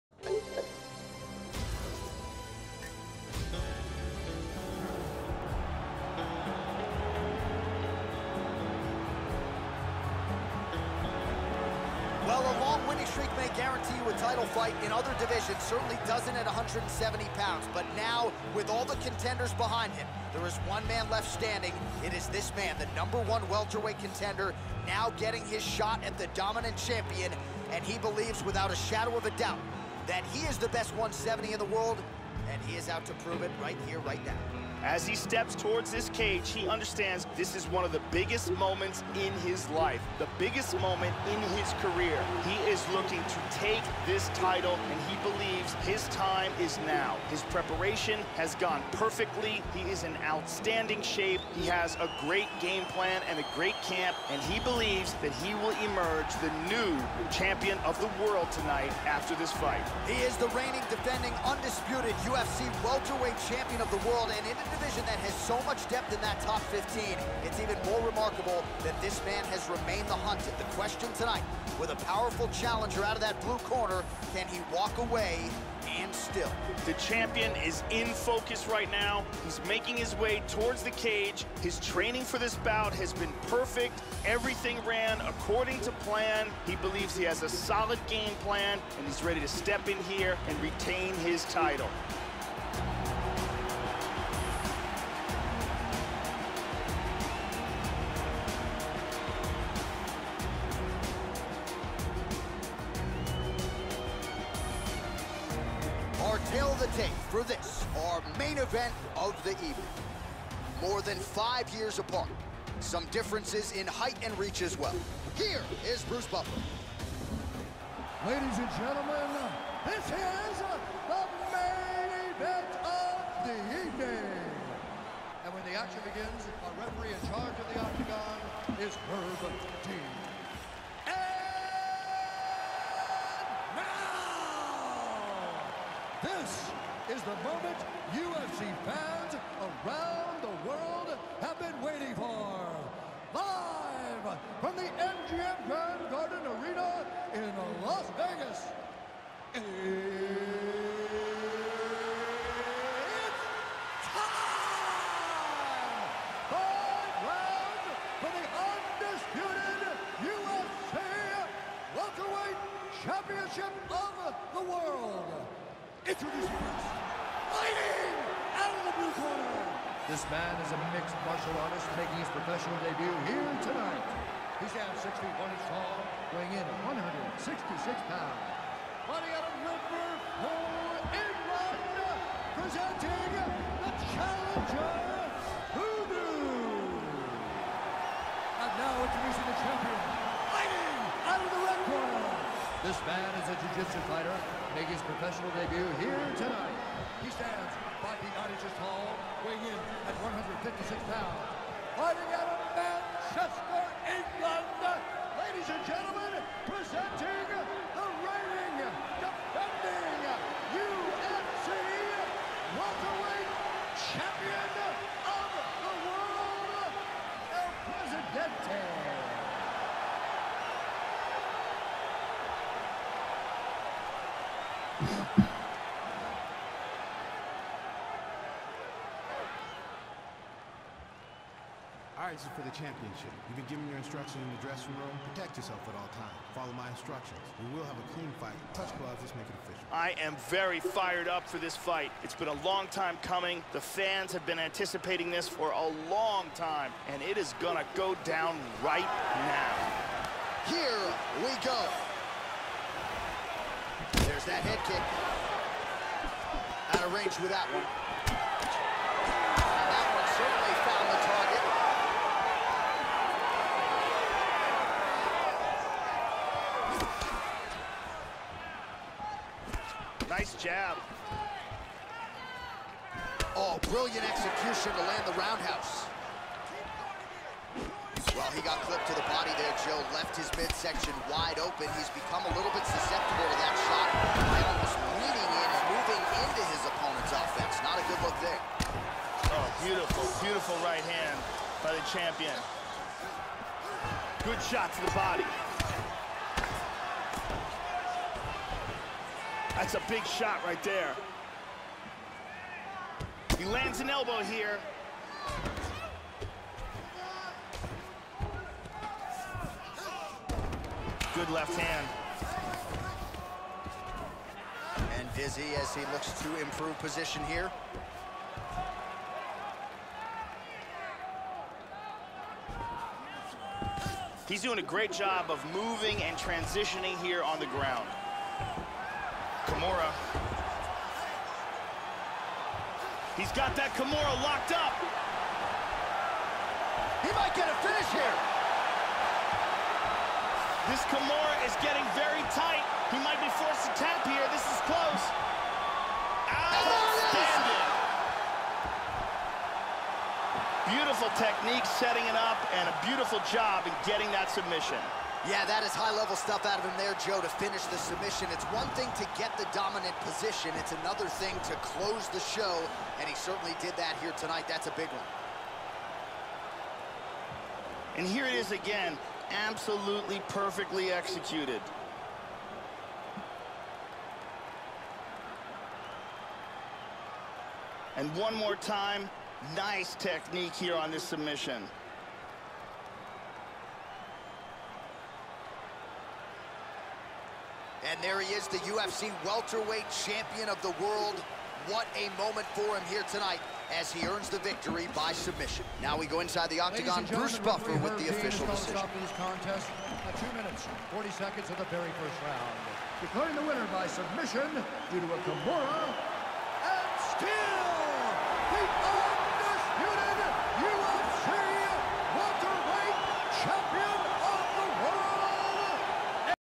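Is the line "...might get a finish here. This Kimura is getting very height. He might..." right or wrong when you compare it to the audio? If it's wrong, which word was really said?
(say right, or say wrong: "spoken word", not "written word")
wrong: "tight", not "height".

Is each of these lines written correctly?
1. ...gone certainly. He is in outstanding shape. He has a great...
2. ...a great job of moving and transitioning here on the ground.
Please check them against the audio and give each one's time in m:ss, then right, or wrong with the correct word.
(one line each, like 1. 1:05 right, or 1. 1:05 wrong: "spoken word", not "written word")
1. 0:48 wrong: "perfectly", not "certainly"
2. 5:24 right.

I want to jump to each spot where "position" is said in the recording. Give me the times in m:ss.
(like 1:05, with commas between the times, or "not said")
5:16, 6:00.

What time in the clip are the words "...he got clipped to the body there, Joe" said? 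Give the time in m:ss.
4:38.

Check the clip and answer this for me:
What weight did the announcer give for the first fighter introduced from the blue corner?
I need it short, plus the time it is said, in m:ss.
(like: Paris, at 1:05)
166 pounds, at 2:56.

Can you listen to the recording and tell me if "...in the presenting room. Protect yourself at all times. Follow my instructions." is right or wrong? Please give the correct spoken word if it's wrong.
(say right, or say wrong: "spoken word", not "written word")
wrong: "dressing", not "presenting".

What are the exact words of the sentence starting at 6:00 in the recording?
It's another thing to close the show, and he certainly did that here tonight.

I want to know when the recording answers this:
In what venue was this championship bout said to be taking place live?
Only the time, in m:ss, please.
2:24.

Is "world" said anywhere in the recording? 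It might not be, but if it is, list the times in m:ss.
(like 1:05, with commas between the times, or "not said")
0:31, 0:58, 1:04, 2:20, 2:44, 6:31.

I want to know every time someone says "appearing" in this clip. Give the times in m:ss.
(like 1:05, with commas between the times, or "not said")
not said.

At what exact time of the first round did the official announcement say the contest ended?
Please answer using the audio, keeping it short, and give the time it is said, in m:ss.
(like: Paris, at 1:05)
2 minutes, 40 seconds, at 6:40.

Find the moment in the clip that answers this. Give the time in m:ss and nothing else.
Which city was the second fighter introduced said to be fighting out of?
3:22.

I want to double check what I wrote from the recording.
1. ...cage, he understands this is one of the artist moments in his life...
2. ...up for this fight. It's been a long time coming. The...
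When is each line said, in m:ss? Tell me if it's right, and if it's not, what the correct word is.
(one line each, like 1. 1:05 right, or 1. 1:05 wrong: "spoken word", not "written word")
1. 0:36 wrong: "biggest", not "artist"
2. 4:01 right.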